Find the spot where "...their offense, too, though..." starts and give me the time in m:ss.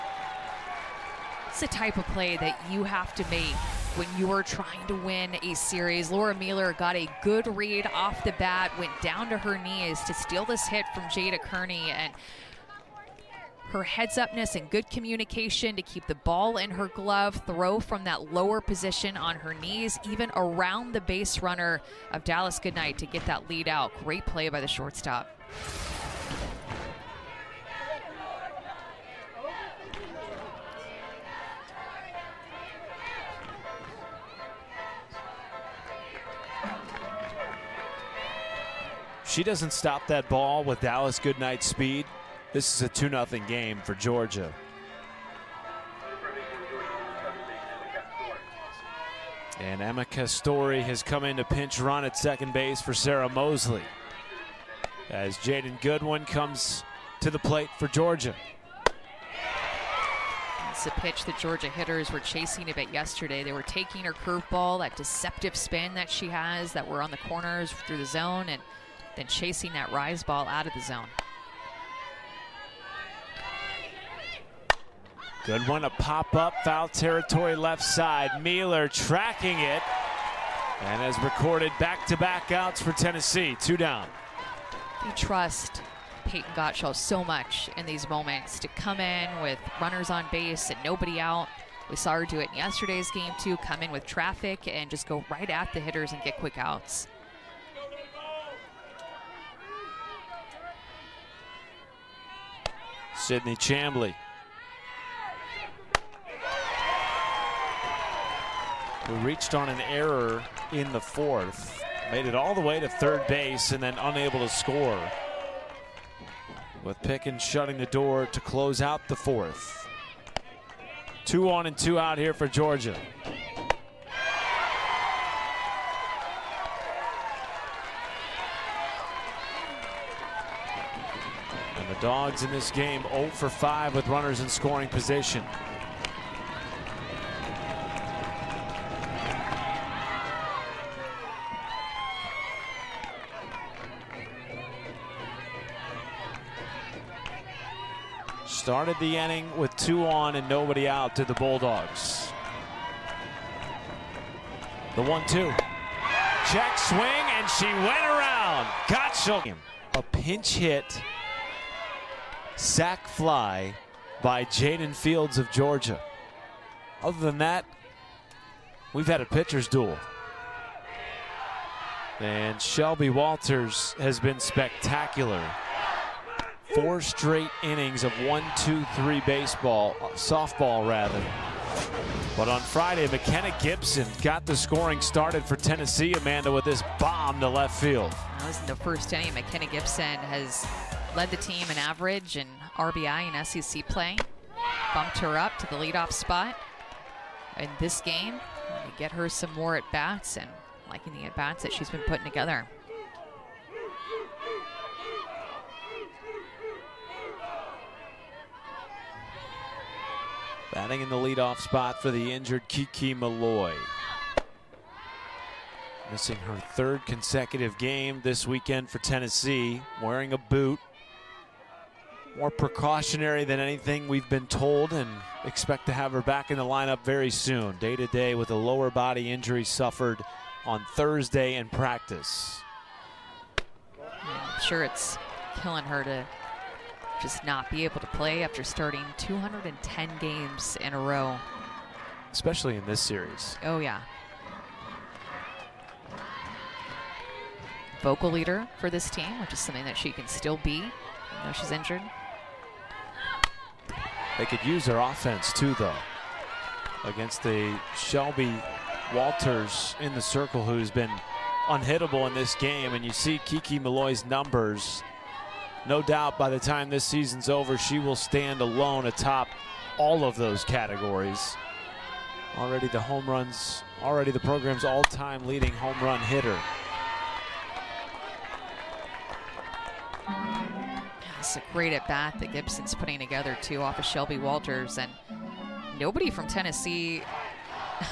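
4:14.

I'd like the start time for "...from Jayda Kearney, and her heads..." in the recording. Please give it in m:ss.
0:10.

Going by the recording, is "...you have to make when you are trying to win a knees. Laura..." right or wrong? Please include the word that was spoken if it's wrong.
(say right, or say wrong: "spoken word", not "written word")
wrong: "series", not "knees".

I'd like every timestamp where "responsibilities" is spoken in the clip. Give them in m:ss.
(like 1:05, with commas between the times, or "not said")
not said.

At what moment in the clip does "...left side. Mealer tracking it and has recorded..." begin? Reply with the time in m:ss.
1:17.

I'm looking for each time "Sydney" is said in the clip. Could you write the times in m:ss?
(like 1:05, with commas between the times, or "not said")
1:43.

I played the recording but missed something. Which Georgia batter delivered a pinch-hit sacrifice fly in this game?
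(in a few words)
Jaden Fields.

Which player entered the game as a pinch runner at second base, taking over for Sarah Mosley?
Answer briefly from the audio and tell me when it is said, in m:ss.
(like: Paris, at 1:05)
Emma Castori, at 0:49.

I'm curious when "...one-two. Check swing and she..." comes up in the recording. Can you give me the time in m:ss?
2:35.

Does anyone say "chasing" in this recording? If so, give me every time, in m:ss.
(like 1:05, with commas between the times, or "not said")
1:02, 1:09.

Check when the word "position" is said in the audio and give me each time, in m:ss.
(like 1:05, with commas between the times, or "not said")
0:18, 2:14.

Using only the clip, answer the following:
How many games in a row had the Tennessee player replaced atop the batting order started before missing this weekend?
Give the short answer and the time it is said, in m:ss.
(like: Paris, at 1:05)
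210, at 3:59.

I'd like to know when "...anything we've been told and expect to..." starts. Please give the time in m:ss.
3:43.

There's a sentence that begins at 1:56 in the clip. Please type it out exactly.
With Pickens shutting the door to close out the fourth.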